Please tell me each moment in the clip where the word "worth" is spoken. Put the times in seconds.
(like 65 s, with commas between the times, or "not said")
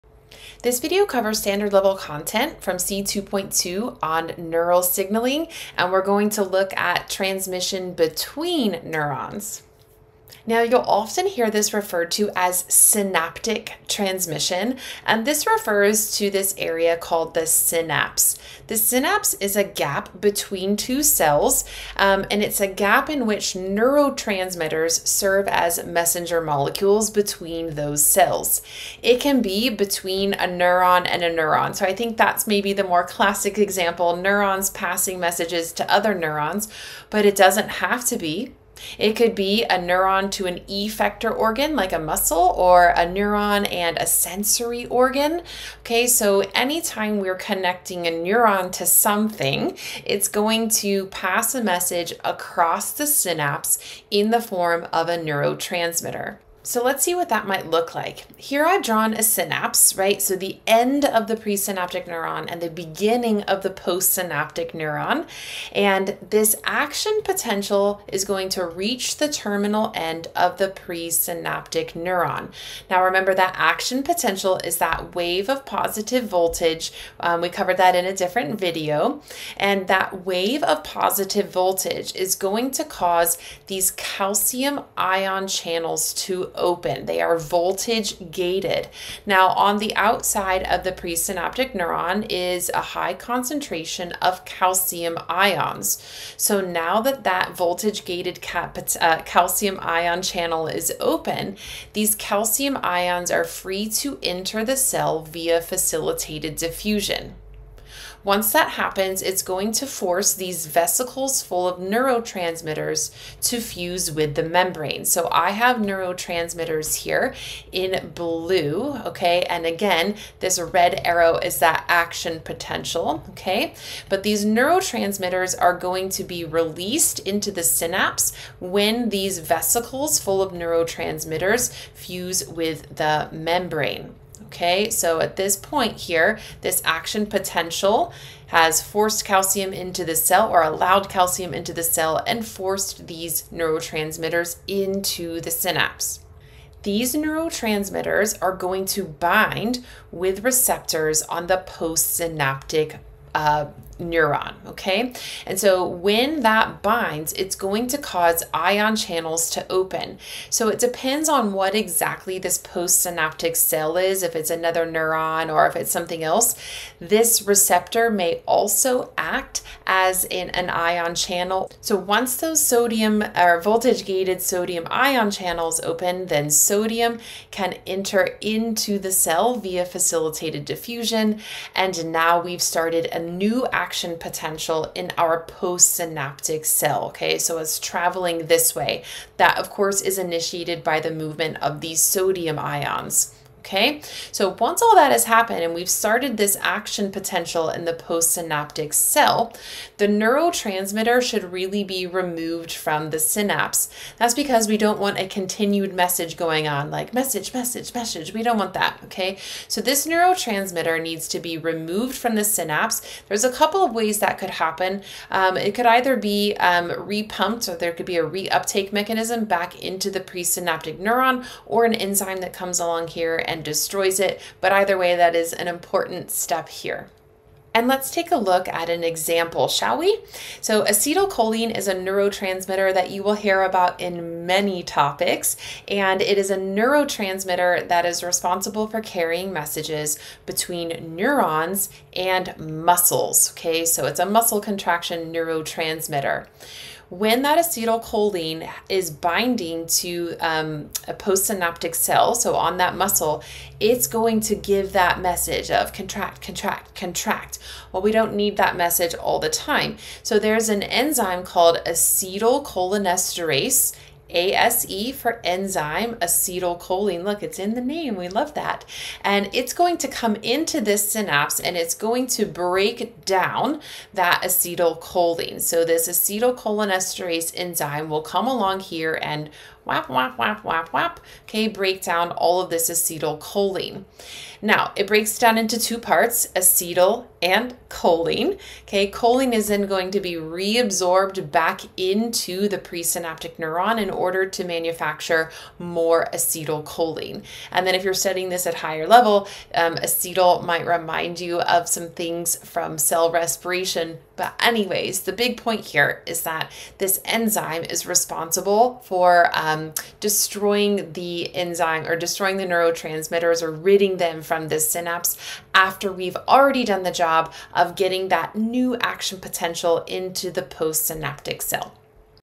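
not said.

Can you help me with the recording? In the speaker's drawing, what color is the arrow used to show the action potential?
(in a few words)
Red.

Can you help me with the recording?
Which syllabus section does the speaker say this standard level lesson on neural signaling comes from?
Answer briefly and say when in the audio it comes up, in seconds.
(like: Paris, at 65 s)
C2.2, at 2 s.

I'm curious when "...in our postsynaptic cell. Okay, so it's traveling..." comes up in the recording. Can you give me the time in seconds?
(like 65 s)
184 s.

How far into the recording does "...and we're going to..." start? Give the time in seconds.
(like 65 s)
5 s.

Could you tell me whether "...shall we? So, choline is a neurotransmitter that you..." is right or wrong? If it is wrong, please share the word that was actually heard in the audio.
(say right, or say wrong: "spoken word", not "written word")
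wrong: "acetylcholine", not "choline".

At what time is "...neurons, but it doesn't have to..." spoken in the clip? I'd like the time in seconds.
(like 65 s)
36 s.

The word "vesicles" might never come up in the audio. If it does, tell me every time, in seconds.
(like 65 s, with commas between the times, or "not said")
110 s, 129 s.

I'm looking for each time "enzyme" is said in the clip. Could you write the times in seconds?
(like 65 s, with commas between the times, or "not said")
221 s, 260 s, 265 s, 277 s, 307 s, 311 s.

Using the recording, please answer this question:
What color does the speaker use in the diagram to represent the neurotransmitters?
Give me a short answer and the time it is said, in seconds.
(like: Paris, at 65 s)
Blue, at 118 s.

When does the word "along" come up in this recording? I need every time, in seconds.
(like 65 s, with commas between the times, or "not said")
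222 s, 278 s.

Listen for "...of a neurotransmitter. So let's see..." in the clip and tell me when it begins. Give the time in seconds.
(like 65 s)
54 s.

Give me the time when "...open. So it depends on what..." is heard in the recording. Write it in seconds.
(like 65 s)
159 s.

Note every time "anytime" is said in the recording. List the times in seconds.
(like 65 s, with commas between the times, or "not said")
46 s.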